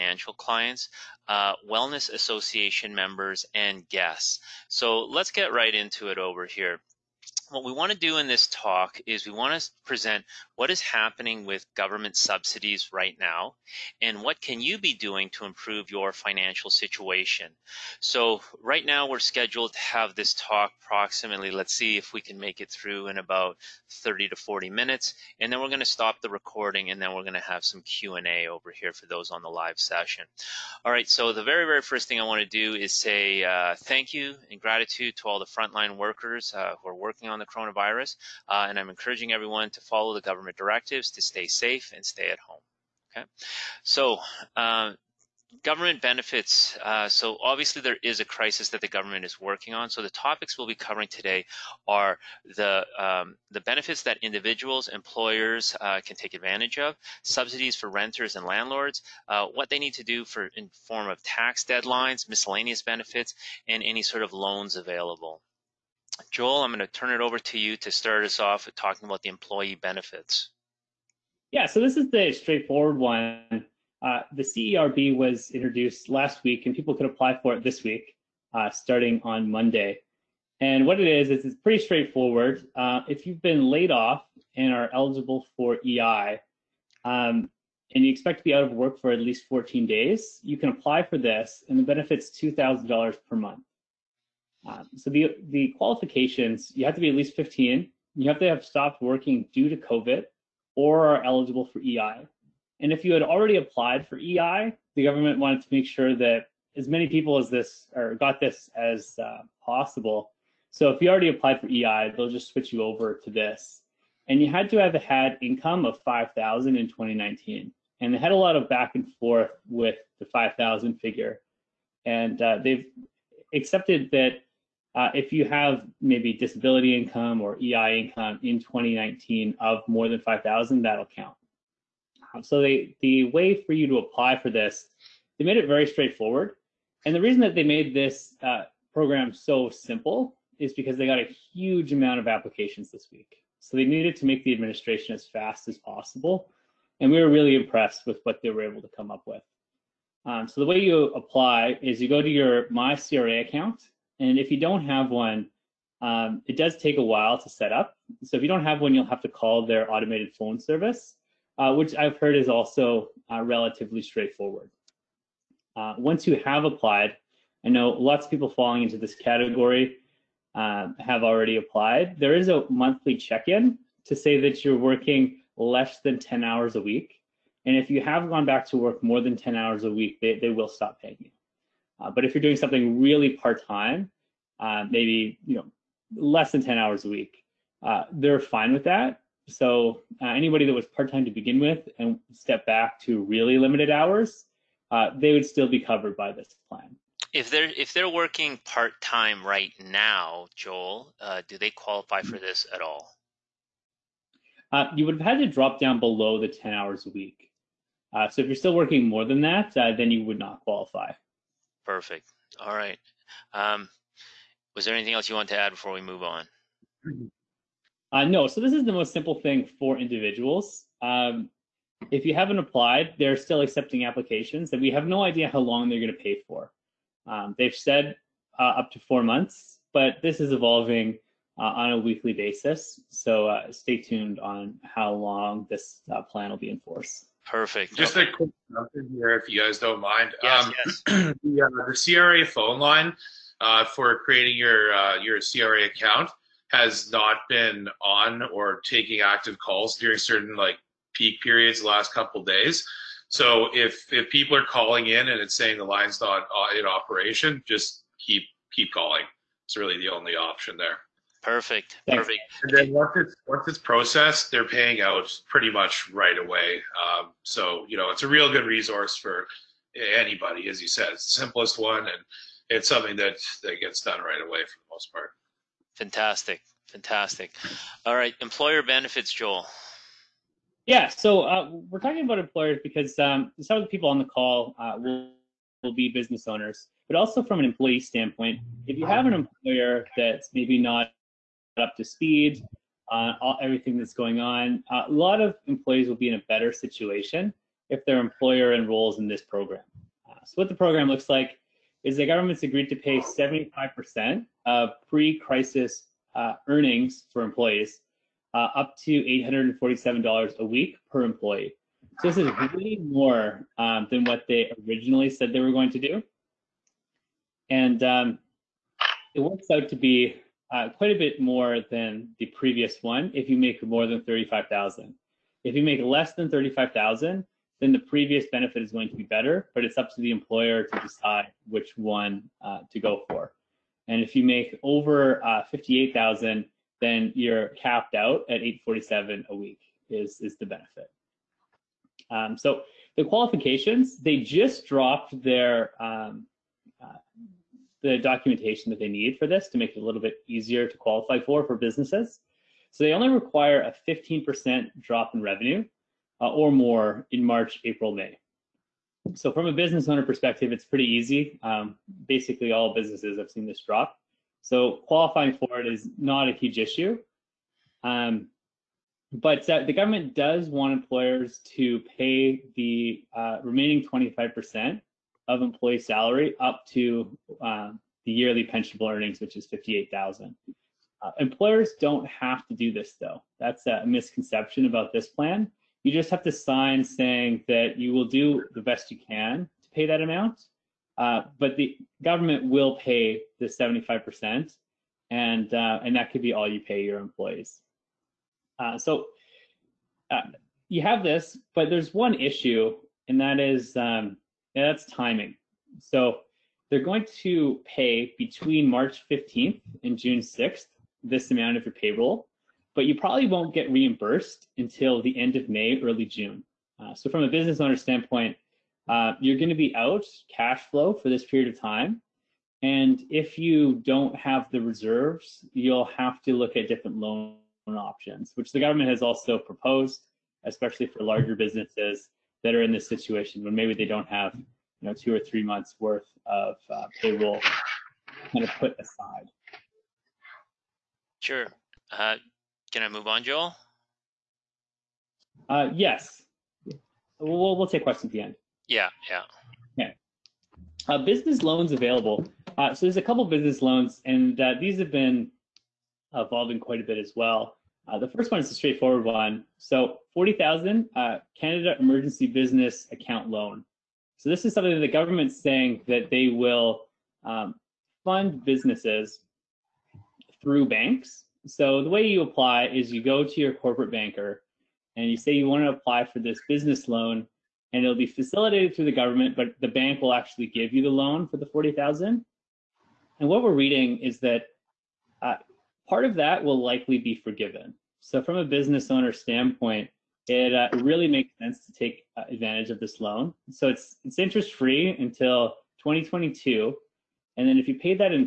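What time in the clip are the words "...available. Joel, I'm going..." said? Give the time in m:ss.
1:04.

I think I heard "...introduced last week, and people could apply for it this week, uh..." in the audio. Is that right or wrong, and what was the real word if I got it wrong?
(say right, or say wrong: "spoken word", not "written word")
right.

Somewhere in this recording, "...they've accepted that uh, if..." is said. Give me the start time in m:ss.
2:02.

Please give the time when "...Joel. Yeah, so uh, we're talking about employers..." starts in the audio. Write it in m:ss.
4:39.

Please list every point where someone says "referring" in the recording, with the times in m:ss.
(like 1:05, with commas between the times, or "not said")
not said.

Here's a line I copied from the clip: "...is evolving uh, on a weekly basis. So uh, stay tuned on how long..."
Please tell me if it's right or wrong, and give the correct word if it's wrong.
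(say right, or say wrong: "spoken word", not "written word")
right.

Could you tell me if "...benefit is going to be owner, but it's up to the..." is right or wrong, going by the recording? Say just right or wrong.
wrong.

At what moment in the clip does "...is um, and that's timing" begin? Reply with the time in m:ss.
6:43.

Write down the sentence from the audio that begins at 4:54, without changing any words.
Uh, a lot of employees will be in a better situation if their employer enrolls in this program.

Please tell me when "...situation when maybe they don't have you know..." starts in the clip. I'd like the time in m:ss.
7:13.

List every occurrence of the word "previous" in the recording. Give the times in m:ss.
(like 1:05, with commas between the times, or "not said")
5:22, 5:27.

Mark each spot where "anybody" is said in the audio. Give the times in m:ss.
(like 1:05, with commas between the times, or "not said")
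3:10, 4:30.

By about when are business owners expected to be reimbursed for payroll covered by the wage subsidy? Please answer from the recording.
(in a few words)
end of May, early June.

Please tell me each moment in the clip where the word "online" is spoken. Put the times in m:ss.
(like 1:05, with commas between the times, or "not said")
not said.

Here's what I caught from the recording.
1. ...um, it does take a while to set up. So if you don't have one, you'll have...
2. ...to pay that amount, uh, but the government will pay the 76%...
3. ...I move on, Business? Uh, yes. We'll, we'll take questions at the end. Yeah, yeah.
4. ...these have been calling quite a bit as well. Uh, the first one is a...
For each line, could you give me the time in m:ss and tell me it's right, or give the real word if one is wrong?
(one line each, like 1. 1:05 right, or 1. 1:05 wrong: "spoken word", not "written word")
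1. 2:36 right
2. 6:29 wrong: "75", not "76"
3. 7:23 wrong: "Joel", not "Business"
4. 7:34 wrong: "evolving", not "calling".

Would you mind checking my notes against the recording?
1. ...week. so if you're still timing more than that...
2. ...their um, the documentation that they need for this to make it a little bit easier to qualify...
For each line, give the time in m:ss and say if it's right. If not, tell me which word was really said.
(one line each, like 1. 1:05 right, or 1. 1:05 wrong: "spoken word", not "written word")
1. 3:27 wrong: "working", not "timing"
2. 5:45 right.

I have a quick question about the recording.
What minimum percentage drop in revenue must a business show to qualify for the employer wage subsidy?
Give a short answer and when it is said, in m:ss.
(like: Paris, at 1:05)
15%, at 5:54.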